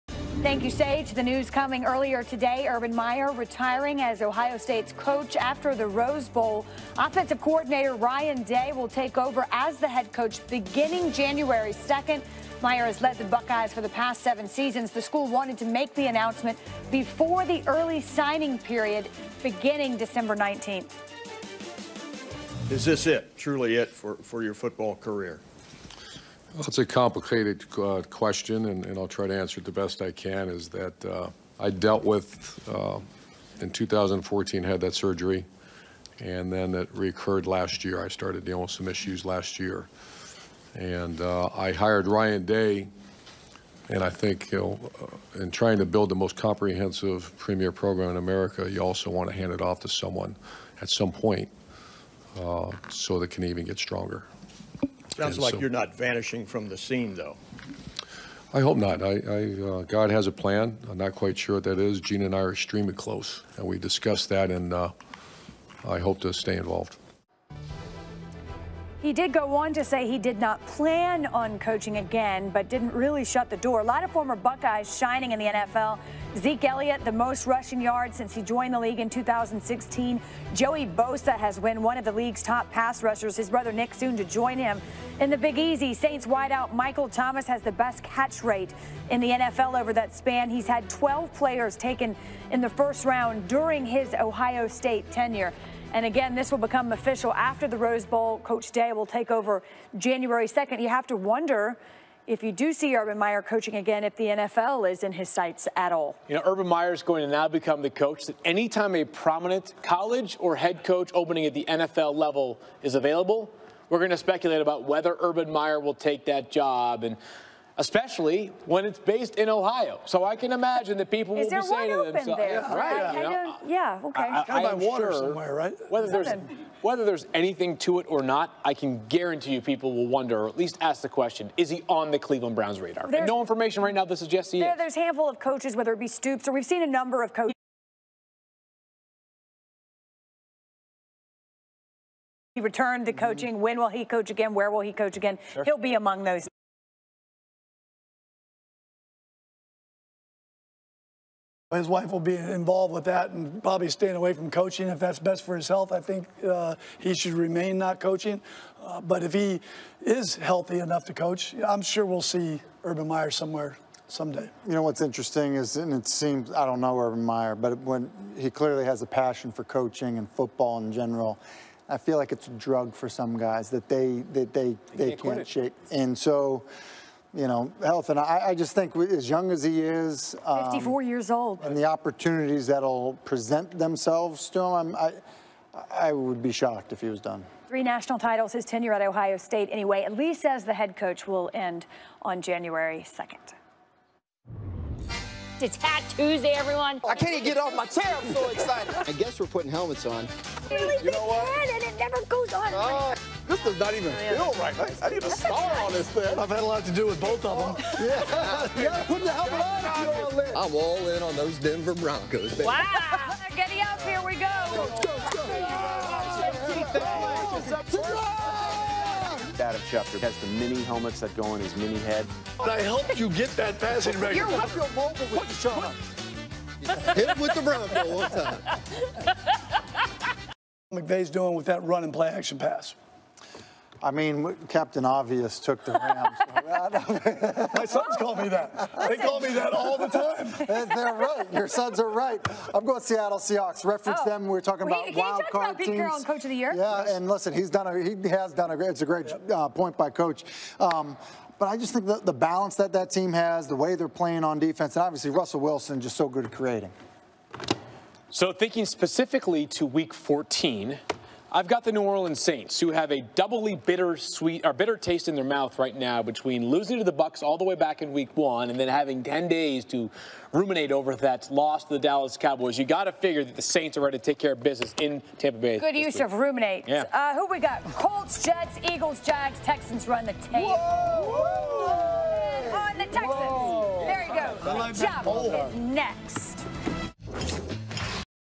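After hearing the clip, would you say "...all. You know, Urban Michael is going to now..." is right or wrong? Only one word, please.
wrong.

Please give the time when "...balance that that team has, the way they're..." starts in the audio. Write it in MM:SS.
04:12.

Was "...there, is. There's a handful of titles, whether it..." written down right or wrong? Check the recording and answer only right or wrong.
wrong.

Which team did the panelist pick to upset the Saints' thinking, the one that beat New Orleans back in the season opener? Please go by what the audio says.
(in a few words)
Bucs.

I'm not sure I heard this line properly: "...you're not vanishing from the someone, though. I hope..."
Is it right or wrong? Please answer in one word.
wrong.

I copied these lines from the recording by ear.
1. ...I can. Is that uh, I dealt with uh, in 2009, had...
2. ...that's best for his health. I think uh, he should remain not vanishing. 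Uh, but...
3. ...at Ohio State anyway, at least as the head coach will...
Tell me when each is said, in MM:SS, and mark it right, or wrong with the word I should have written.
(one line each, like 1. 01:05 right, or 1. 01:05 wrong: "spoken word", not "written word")
1. 00:30 wrong: "2014", not "2009"
2. 02:34 wrong: "coaching", not "vanishing"
3. 03:08 right.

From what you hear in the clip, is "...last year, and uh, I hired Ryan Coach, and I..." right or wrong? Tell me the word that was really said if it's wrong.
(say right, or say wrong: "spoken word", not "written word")
wrong: "Day", not "Coach".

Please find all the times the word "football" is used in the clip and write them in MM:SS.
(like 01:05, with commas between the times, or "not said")
00:24, 02:50.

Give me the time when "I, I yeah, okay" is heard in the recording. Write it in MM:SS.
02:03.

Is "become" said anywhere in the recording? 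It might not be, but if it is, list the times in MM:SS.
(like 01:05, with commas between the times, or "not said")
01:36, 01:47.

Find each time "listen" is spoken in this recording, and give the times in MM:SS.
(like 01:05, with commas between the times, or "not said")
04:07.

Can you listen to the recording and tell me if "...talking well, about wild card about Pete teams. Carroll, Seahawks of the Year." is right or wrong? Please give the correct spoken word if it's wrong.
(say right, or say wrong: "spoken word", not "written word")
wrong: "Coach", not "Seahawks".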